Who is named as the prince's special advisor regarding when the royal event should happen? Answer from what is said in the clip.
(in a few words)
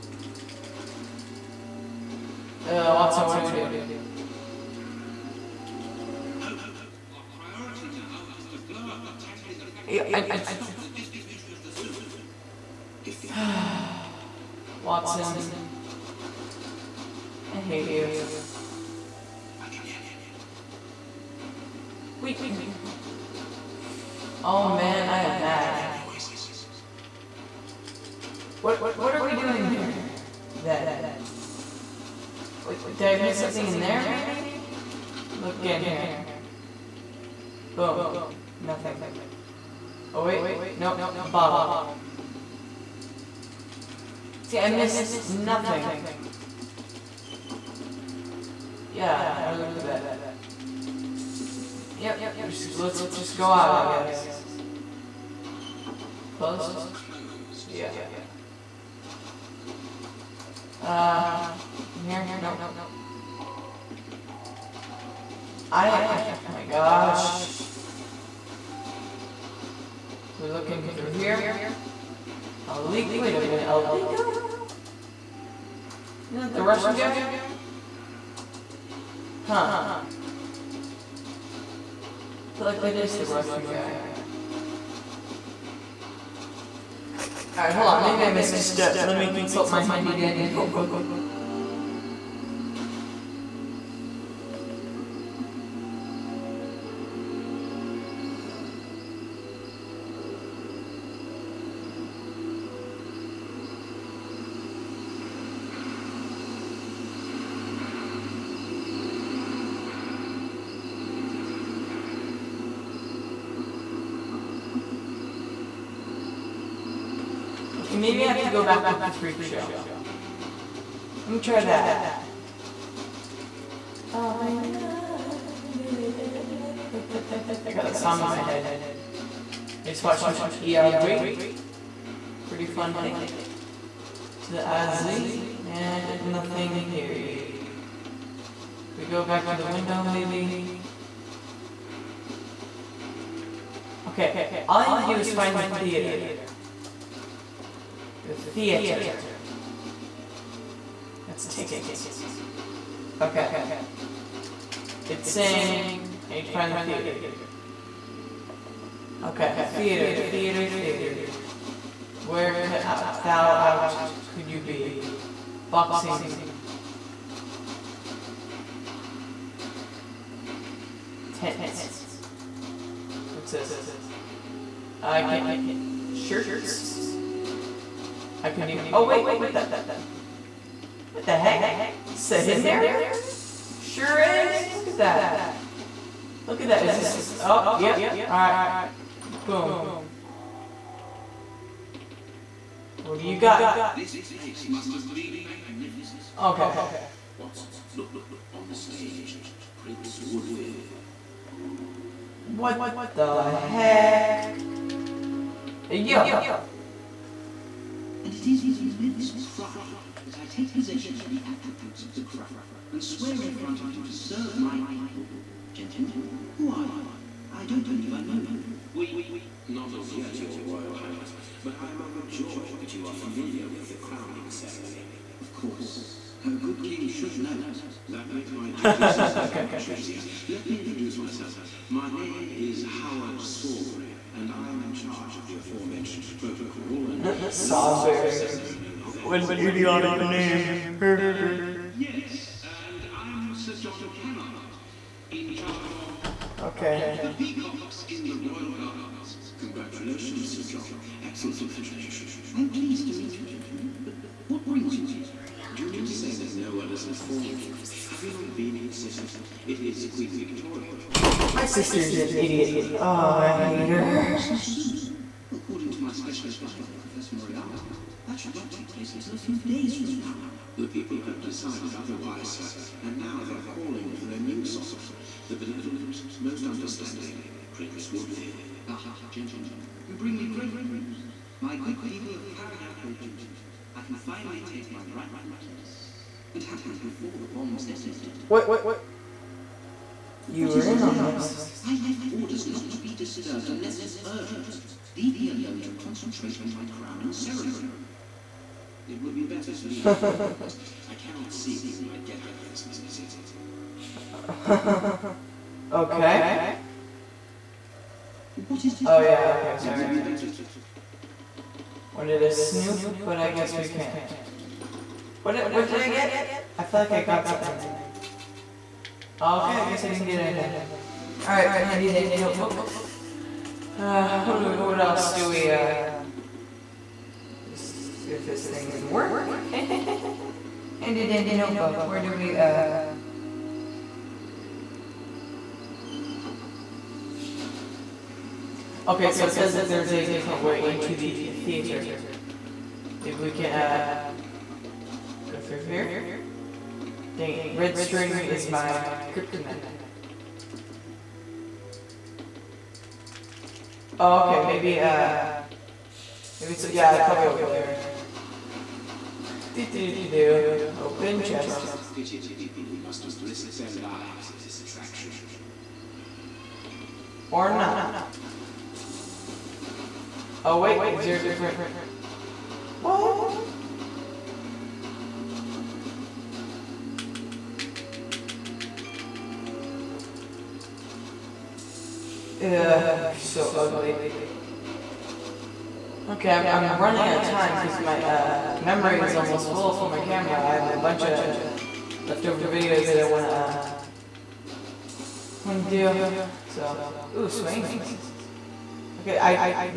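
Professor Moriarty.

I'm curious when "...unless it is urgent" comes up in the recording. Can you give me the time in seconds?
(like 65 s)
293 s.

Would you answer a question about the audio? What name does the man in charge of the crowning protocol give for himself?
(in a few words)
Howard Sawbury.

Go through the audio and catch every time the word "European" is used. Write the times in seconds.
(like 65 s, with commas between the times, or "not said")
not said.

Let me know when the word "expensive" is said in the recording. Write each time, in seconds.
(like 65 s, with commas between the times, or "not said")
not said.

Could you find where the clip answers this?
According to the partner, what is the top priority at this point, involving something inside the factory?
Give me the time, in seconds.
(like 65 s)
8 s.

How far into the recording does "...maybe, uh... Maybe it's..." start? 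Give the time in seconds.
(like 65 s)
354 s.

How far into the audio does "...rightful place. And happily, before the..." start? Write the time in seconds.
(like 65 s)
285 s.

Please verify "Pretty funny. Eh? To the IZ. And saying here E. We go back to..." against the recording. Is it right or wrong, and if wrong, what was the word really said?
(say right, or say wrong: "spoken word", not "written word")
wrong: "nothing", not "saying".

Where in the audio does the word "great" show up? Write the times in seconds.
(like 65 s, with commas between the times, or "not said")
280 s.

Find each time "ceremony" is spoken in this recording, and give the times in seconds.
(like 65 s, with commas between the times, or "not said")
224 s, 297 s.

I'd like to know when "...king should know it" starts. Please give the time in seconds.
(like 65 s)
226 s.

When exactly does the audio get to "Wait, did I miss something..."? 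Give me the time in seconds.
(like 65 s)
32 s.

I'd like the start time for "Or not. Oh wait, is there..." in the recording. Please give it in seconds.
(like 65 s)
367 s.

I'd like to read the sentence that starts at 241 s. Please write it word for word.
uh, yes, and I'm Sir John Kennard, in charge of okay.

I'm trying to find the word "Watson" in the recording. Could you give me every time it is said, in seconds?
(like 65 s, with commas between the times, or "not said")
2 s, 14 s, 197 s.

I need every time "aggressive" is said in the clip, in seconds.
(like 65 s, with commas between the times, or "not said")
not said.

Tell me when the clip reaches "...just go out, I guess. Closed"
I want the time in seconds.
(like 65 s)
53 s.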